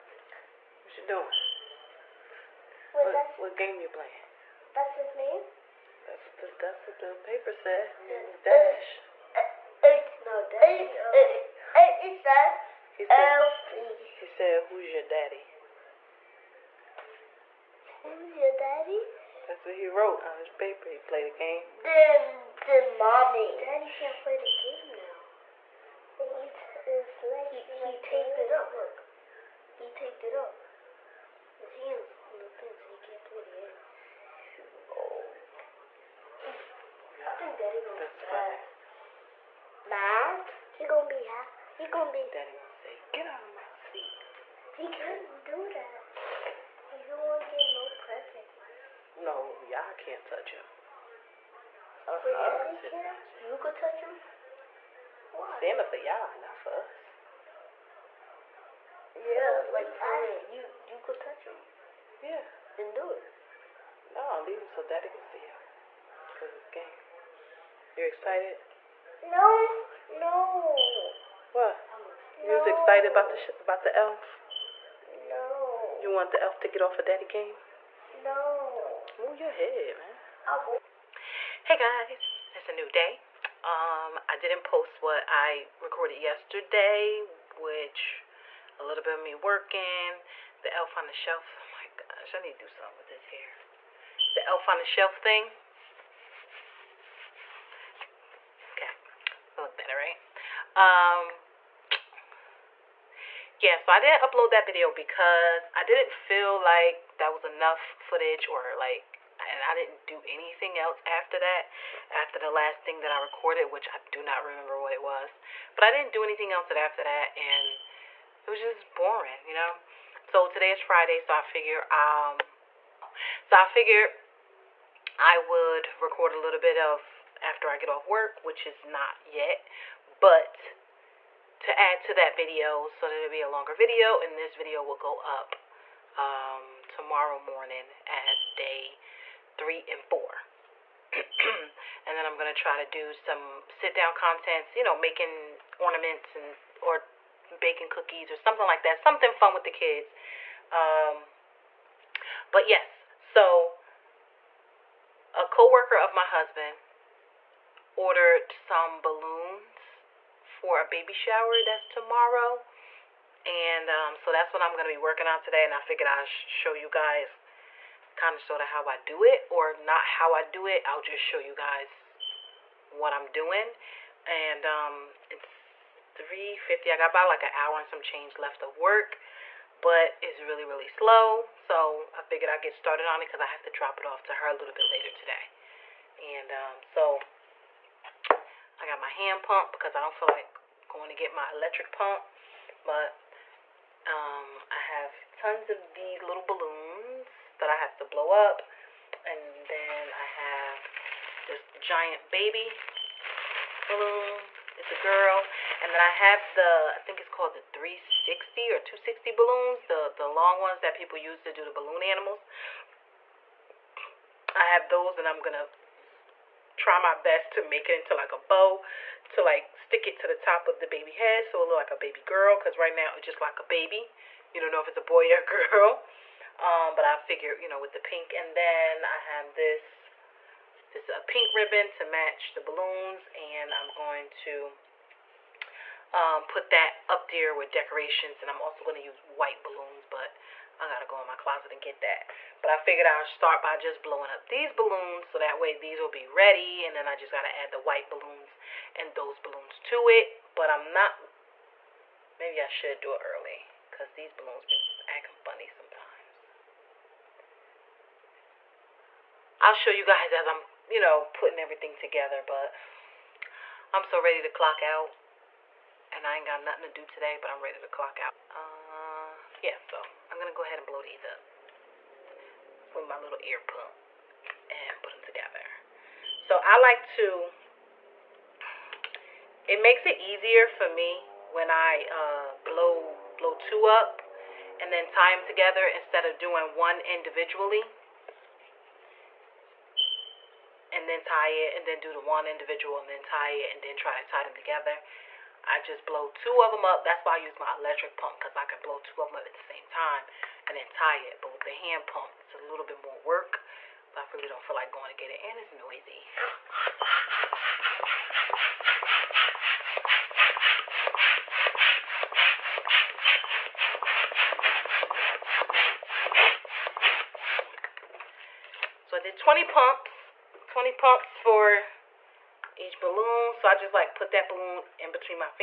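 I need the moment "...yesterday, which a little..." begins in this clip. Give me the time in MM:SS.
01:26.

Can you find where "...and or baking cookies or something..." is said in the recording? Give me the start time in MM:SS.
02:26.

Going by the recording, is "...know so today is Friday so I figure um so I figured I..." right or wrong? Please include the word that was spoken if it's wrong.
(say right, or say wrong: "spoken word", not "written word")
right.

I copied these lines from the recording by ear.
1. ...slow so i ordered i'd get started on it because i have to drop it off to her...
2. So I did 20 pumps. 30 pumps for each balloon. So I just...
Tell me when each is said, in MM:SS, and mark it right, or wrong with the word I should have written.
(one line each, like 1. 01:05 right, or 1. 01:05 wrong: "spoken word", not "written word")
1. 03:00 wrong: "figured", not "ordered"
2. 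05:19 wrong: "20", not "30".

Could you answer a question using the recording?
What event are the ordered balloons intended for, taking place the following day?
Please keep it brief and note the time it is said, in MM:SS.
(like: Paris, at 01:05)
baby shower, at 02:40.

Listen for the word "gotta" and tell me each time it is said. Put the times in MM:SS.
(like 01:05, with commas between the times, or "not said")
04:00, 04:07.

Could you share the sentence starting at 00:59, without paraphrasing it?
Yeah, so, like for You you could touch him.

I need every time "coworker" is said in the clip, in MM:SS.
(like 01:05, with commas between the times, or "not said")
02:35.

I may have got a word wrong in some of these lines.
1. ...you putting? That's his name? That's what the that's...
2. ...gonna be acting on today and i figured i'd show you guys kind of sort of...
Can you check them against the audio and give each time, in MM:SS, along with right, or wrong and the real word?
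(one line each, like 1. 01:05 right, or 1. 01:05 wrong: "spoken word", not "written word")
1. 00:03 wrong: "playing", not "putting"
2. 02:44 wrong: "working", not "acting".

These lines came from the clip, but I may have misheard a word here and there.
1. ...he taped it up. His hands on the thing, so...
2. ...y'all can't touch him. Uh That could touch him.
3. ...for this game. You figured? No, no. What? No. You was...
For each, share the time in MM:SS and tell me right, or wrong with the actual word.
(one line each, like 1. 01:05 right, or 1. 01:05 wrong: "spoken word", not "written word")
1. 00:29 right
2. 00:49 wrong: "You", not "That"
3. 01:06 wrong: "excited", not "figured".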